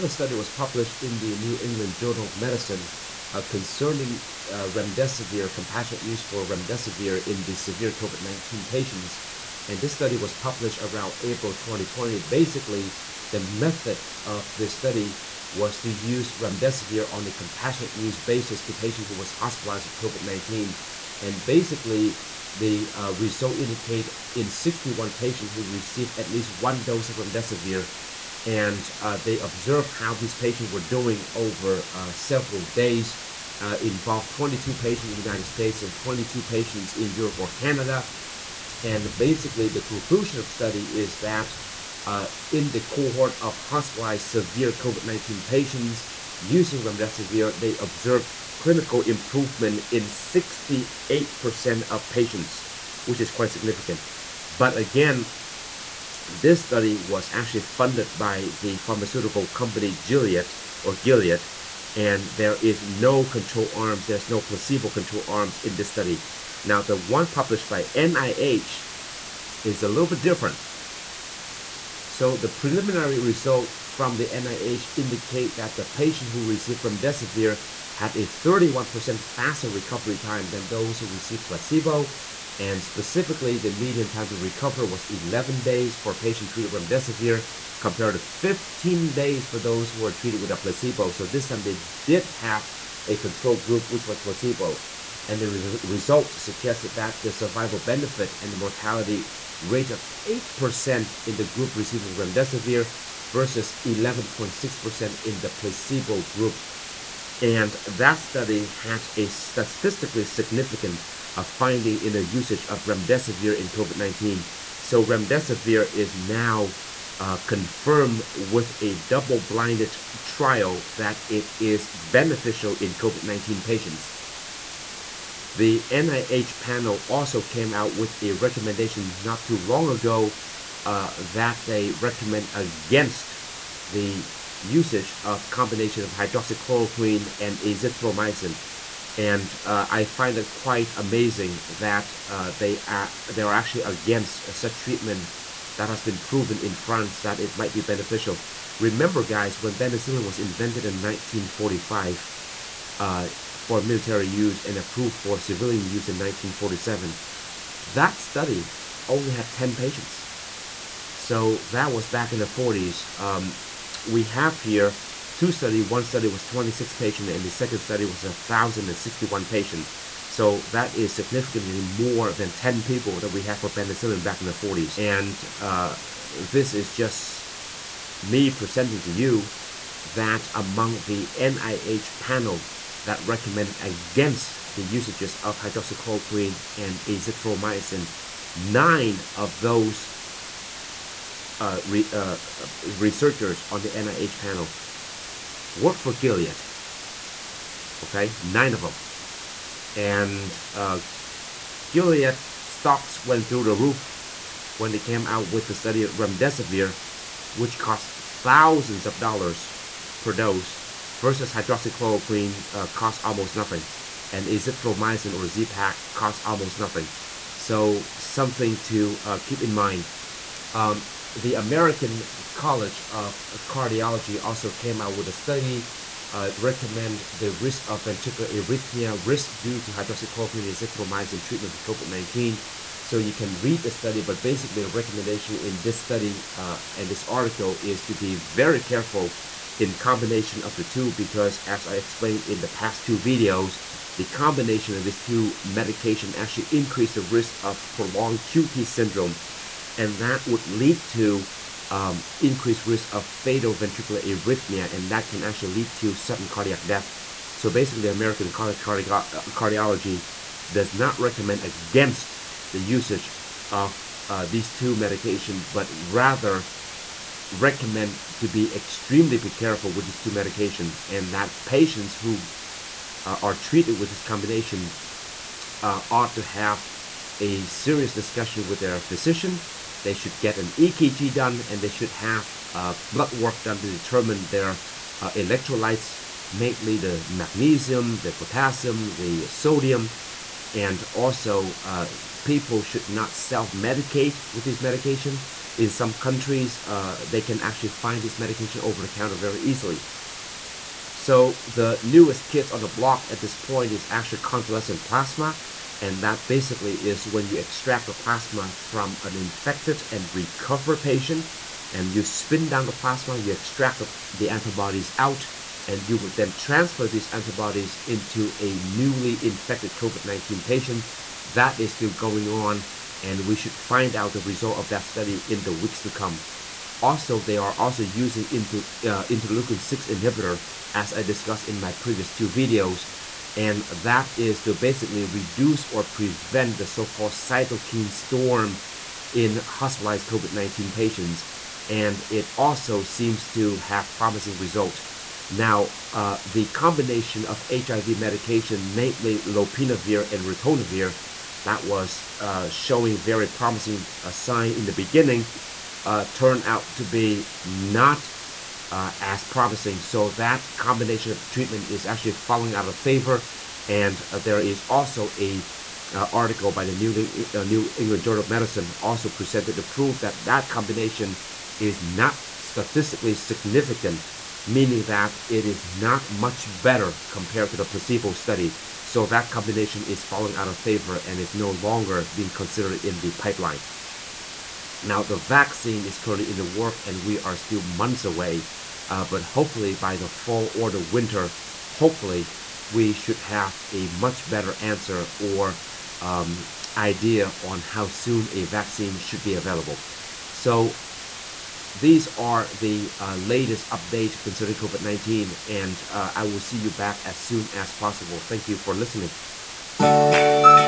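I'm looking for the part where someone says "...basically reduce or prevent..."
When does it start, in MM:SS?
05:34.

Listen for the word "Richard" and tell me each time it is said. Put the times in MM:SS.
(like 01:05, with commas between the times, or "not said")
not said.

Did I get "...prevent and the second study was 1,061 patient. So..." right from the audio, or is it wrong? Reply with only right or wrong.
wrong.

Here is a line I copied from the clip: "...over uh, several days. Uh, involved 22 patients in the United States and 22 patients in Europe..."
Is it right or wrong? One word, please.
right.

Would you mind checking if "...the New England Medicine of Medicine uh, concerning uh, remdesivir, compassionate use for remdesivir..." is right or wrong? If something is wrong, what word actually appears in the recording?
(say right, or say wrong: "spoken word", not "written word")
wrong: "Journal", not "Medicine".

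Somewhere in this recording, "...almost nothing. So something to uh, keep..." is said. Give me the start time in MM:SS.
03:36.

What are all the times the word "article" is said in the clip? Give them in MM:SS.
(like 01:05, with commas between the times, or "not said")
03:57, 06:06.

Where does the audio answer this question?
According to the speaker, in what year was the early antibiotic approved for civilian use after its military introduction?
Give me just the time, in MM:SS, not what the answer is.
02:36.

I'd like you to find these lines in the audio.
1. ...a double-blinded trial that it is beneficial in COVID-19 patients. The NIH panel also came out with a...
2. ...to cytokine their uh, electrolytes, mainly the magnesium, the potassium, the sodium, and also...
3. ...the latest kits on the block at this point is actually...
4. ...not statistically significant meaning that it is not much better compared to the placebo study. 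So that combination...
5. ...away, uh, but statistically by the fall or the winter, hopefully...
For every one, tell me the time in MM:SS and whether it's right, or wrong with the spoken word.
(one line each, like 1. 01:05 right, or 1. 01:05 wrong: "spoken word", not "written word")
1. 01:58 right
2. 04:43 wrong: "determine", not "cytokine"
3. 05:01 wrong: "newest", not "latest"
4. 06:12 right
5. 06:28 wrong: "hopefully", not "statistically".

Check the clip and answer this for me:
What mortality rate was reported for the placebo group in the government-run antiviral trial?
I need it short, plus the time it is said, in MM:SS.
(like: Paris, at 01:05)
11.6%, at 01:43.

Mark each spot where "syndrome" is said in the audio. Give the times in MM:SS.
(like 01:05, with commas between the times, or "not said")
04:08.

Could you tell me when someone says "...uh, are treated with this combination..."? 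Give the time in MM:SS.
04:33.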